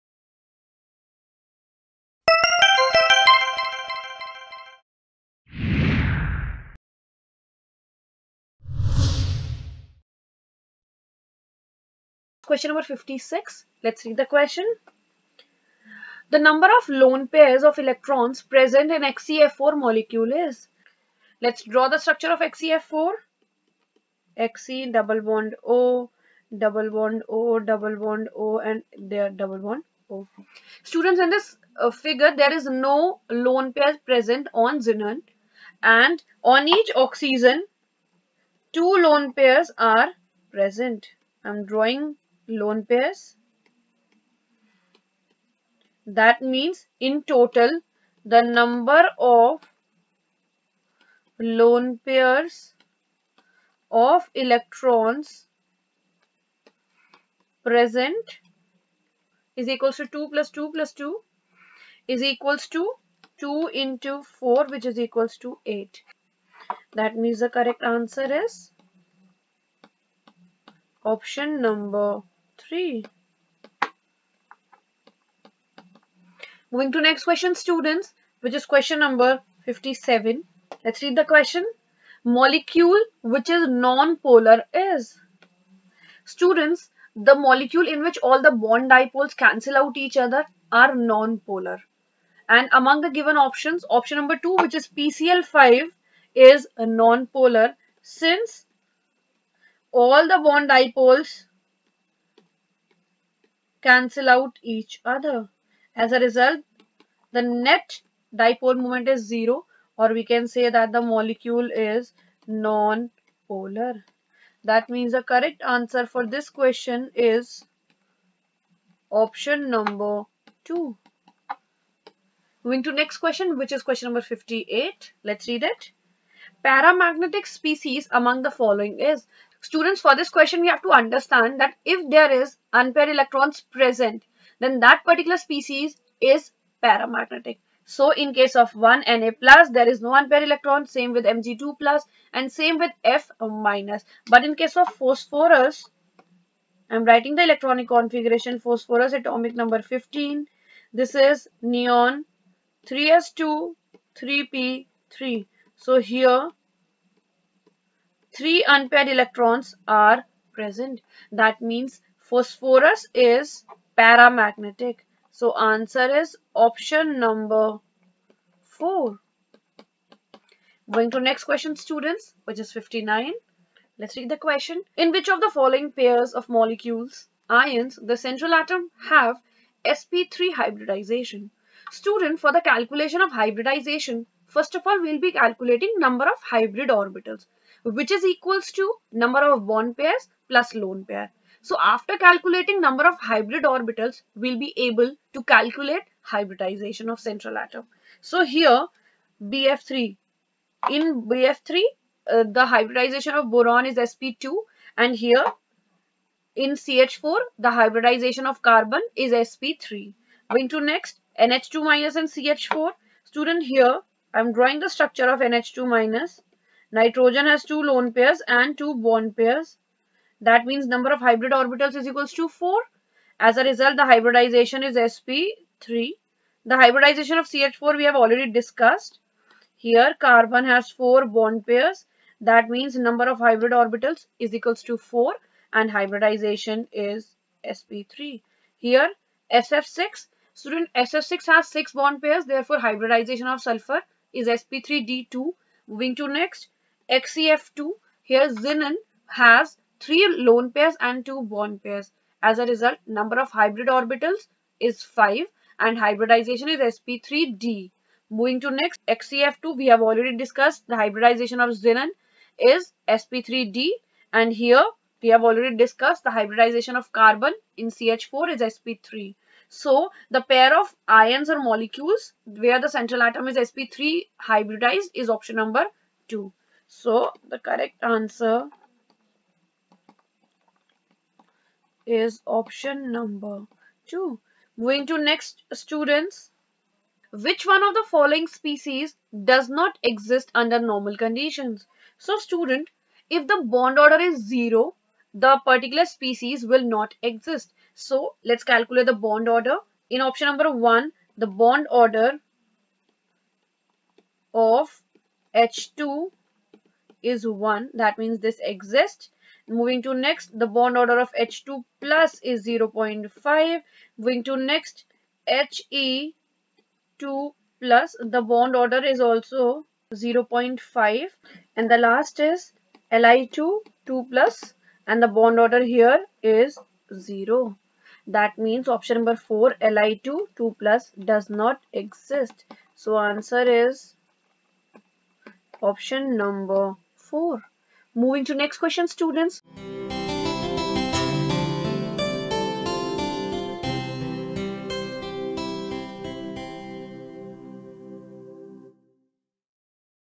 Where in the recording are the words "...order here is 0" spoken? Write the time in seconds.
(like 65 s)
325 s.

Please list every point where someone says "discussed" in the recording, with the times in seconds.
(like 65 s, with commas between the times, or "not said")
228 s, 260 s, 265 s.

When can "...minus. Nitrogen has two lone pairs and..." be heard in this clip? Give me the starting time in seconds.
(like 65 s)
215 s.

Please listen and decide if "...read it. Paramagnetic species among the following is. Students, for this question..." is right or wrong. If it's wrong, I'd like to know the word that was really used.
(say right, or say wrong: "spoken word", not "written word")
right.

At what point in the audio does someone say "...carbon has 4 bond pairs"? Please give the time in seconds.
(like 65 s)
230 s.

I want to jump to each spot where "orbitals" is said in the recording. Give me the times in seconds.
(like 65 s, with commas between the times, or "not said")
186 s, 193 s, 221 s, 233 s, 253 s.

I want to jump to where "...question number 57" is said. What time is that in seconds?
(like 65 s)
78 s.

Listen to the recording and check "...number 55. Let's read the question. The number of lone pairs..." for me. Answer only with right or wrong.
wrong.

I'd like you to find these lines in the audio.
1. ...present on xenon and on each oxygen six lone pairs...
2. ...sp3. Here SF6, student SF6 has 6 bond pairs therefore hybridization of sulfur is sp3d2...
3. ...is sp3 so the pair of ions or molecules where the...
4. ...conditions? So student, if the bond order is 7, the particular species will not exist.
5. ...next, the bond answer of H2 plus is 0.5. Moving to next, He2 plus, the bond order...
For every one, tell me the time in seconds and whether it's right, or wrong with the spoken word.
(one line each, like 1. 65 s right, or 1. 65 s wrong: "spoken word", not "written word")
1. 34 s wrong: "two", not "six"
2. 237 s right
3. 268 s right
4. 291 s wrong: "0", not "7"
5. 310 s wrong: "order", not "answer".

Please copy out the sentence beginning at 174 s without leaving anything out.
In which of the following pairs of molecules, ions, the central atom have sp3 hybridization?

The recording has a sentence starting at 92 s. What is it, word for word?
And among the given options, option number 2 which is PCl5 is non-polar since all the bond dipoles cancel out each other.